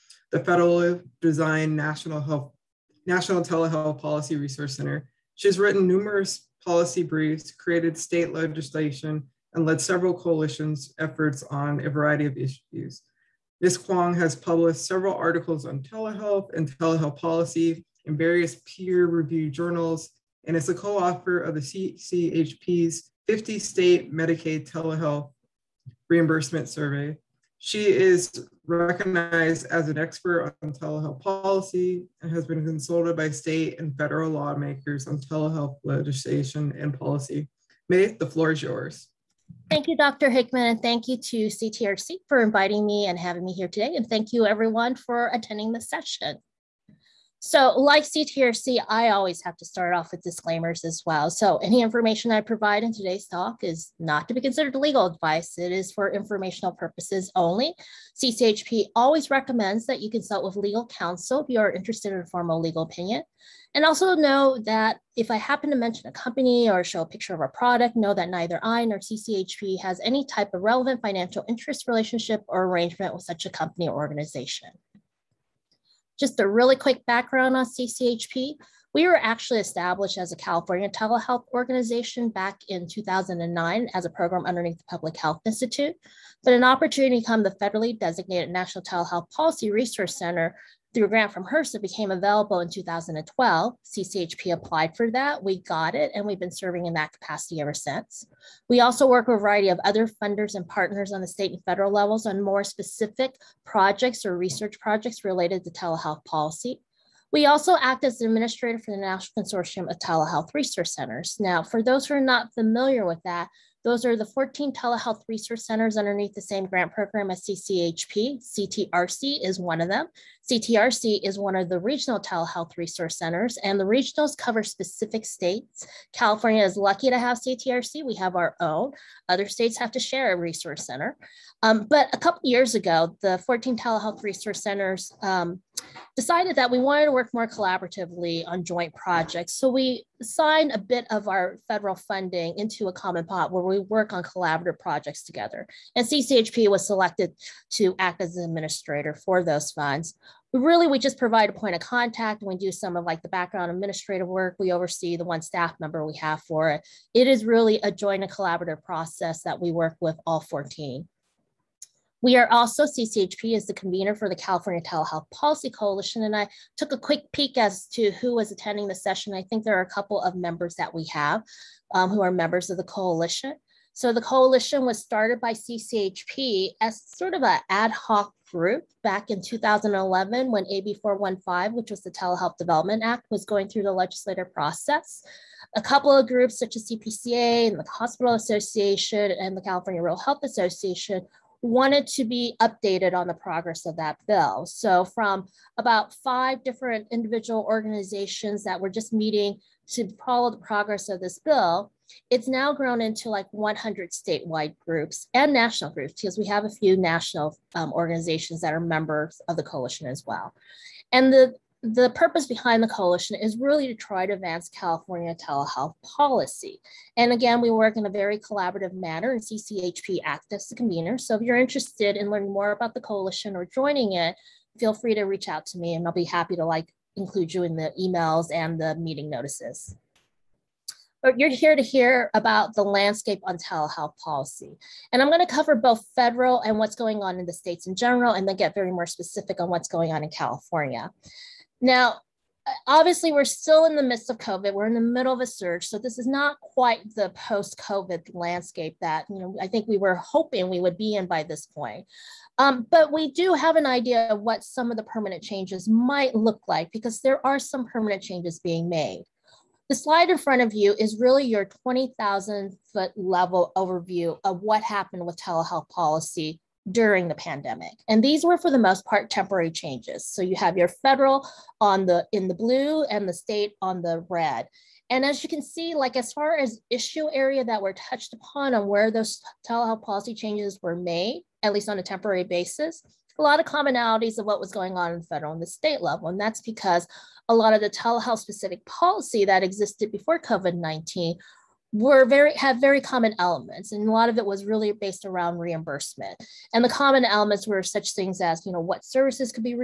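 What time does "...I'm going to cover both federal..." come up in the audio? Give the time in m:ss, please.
3:55.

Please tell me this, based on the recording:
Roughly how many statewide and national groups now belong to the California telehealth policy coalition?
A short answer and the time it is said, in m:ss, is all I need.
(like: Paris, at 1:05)
100, at 3:23.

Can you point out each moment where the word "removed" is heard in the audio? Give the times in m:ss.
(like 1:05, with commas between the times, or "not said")
not said.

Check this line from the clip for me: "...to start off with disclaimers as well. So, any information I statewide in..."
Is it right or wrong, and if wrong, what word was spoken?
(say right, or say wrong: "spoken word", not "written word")
wrong: "provide", not "statewide".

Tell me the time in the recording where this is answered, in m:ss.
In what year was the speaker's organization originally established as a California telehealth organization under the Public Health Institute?
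1:22.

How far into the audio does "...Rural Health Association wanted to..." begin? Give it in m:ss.
3:10.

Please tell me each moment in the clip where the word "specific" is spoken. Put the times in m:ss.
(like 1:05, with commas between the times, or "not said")
1:42, 2:04, 3:59, 4:48.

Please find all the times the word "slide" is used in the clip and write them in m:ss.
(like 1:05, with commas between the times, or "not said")
4:19.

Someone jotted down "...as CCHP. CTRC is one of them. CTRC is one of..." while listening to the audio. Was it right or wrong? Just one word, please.
right.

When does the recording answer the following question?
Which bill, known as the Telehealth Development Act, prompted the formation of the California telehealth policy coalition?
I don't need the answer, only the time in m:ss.
3:00.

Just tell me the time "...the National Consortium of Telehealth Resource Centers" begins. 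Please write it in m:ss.
1:48.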